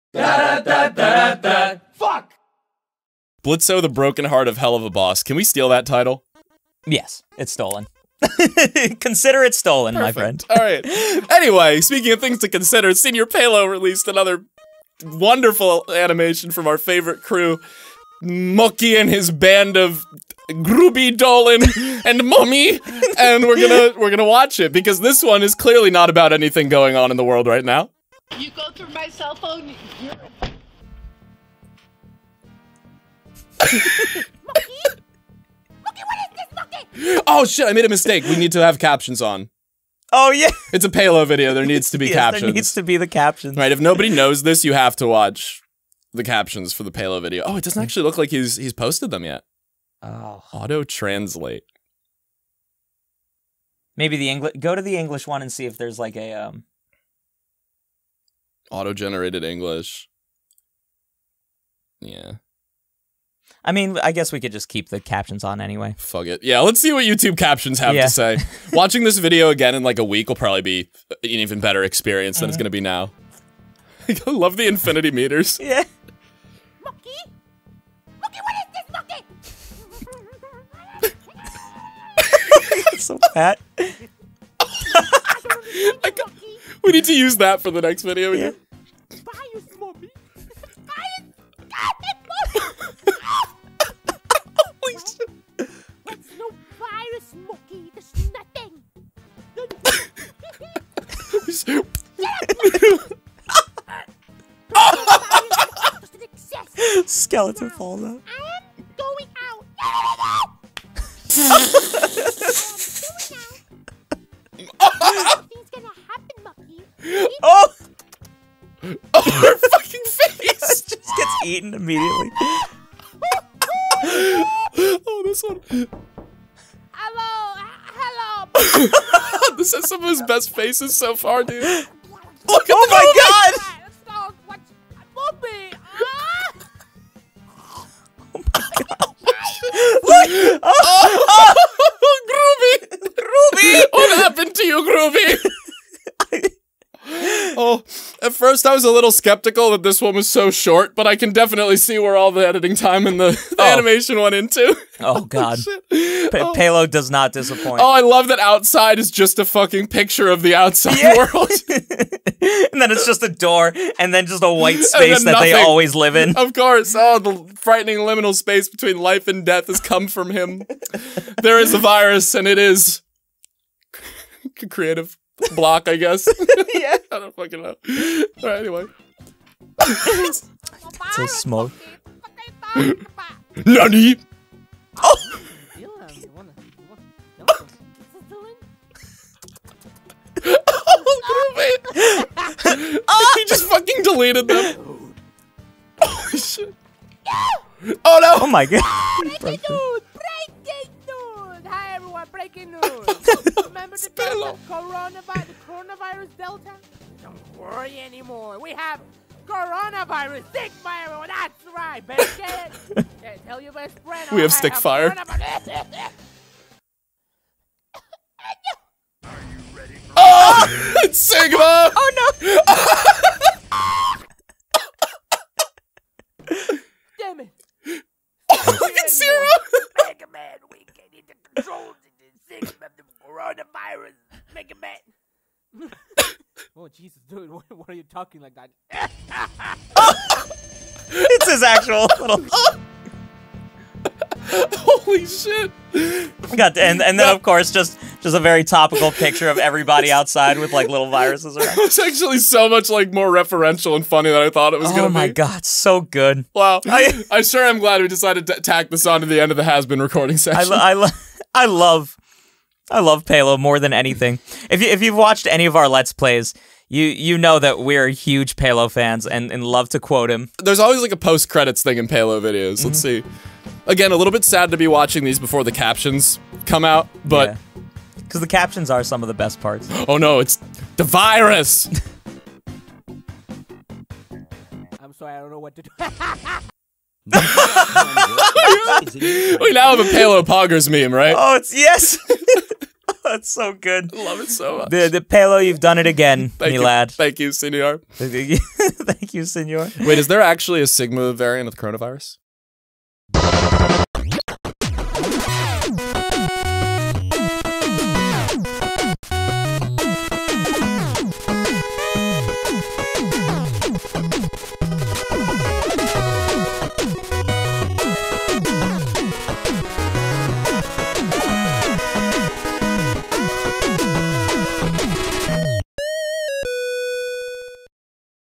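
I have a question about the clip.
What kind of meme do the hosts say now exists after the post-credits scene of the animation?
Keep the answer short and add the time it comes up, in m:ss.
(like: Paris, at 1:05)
Pelo Poggers meme, at 4:50.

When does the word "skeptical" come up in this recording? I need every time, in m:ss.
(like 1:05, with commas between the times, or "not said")
2:29.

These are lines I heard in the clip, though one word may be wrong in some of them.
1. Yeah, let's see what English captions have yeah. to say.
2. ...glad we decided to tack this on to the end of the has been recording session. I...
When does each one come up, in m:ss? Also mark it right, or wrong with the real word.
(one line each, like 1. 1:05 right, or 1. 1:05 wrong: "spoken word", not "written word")
1. 1:06 wrong: "YouTube", not "English"
2. 4:17 right.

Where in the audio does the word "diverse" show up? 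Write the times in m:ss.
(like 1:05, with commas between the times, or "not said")
not said.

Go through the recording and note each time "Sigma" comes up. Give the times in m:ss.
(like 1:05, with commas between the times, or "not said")
3:41, 5:00.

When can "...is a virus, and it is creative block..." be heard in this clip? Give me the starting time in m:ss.
2:51.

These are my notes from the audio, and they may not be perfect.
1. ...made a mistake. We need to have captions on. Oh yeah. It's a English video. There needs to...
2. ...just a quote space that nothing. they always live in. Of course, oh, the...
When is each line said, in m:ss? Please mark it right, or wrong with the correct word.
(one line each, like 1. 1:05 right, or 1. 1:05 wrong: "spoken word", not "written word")
1. 0:37 wrong: "Pelo", not "English"
2. 2:44 wrong: "white", not "quote".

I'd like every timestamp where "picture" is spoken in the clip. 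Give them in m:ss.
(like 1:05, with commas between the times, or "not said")
2:39, 4:09.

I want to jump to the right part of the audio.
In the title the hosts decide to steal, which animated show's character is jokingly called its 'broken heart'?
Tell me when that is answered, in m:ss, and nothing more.
0:04.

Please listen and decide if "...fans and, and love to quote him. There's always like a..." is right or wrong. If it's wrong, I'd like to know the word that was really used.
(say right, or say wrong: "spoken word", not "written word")
right.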